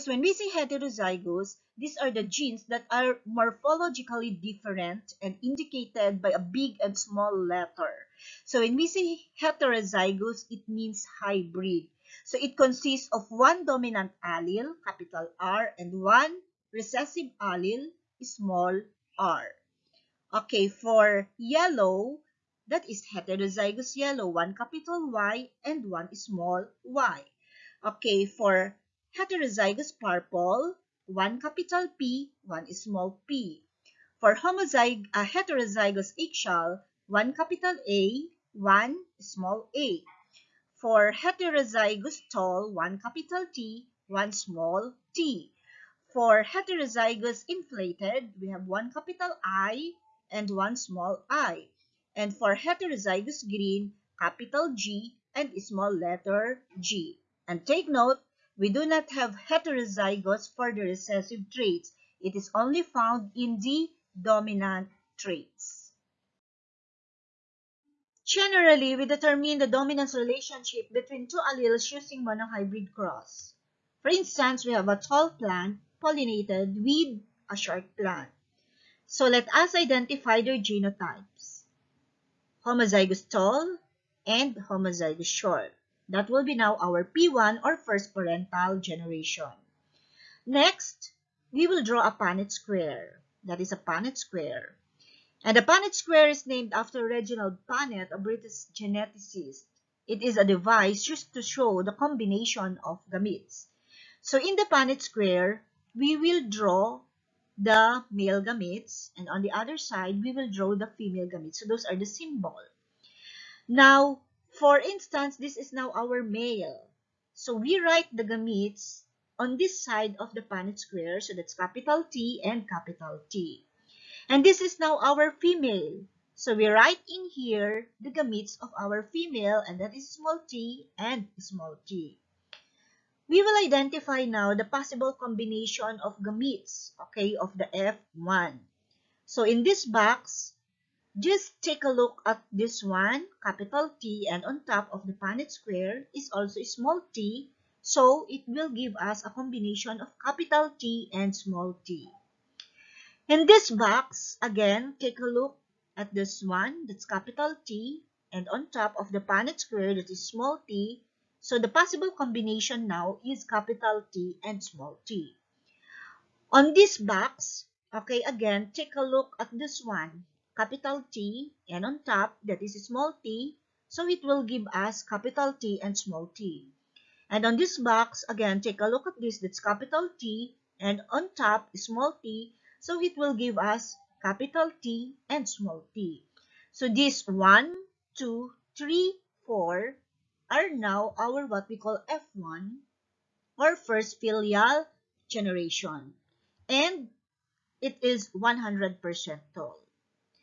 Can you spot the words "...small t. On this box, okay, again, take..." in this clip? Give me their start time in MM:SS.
02:44.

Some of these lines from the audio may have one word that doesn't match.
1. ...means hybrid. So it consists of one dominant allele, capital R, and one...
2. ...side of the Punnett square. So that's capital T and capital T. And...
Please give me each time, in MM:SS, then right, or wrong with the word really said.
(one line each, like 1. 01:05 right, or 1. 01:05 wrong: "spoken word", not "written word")
1. 00:10 right
2. 01:59 right.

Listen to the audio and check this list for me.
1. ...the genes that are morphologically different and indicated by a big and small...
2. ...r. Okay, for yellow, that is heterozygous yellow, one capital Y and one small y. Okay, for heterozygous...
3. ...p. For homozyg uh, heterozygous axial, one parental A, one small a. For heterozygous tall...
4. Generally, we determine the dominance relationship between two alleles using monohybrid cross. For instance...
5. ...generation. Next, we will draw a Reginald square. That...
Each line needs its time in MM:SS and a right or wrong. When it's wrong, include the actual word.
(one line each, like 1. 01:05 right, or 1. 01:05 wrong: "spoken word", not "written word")
1. 00:02 right
2. 00:19 right
3. 00:33 wrong: "capital", not "parental"
4. 01:08 right
5. 01:28 wrong: "Punnett", not "Reginald".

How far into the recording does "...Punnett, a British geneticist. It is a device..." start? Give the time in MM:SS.
01:37.